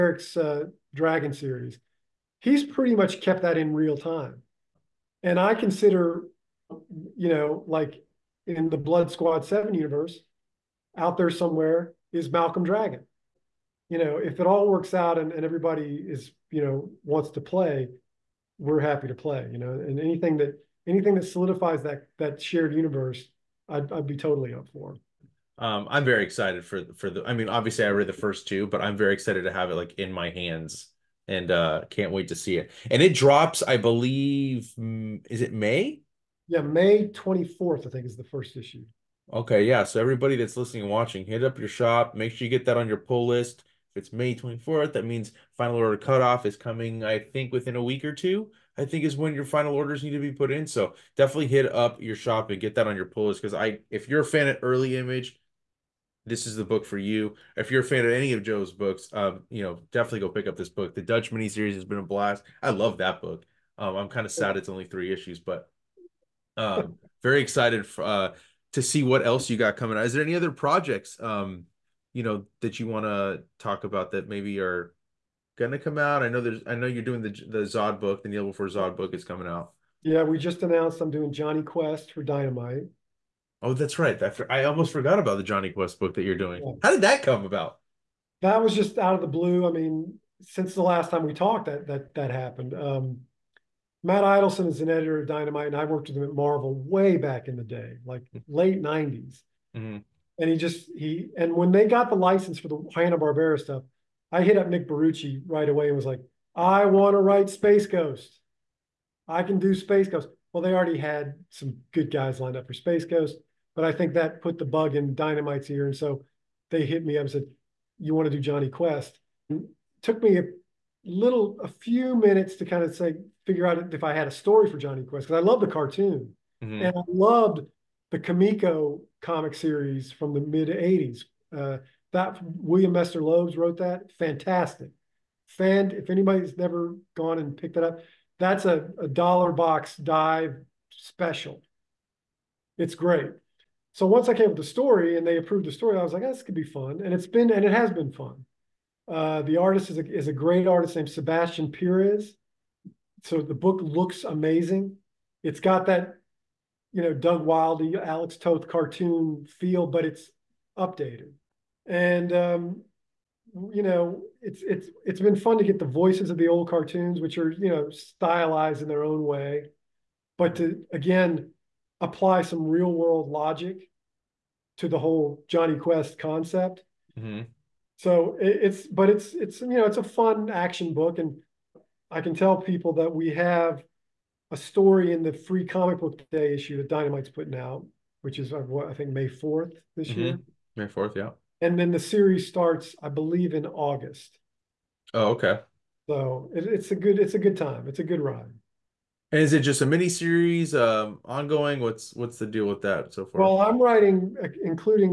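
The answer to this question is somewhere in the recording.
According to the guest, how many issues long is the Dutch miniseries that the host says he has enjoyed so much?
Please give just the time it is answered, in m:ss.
1:04.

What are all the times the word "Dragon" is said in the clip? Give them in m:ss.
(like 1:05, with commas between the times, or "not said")
0:00, 0:12.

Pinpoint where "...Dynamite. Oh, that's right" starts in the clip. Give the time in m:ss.
1:22.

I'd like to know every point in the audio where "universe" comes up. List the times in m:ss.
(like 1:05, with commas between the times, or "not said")
0:09, 0:22.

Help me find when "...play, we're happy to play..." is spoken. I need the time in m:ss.
0:17.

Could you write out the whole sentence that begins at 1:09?
Is there any other projects um you know that you want to talk about that maybe are gonna come out?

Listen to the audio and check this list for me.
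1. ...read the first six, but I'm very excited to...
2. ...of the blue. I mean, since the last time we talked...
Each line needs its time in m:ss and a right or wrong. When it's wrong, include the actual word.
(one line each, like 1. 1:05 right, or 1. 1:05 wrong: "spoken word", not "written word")
1. 0:27 wrong: "two", not "six"
2. 1:29 right.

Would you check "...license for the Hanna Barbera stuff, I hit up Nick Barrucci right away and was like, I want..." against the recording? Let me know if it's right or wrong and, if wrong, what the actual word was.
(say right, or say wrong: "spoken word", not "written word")
right.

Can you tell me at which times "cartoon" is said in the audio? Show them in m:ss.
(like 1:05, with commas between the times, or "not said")
2:05, 2:38, 2:46.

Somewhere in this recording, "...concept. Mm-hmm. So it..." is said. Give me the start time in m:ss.
2:56.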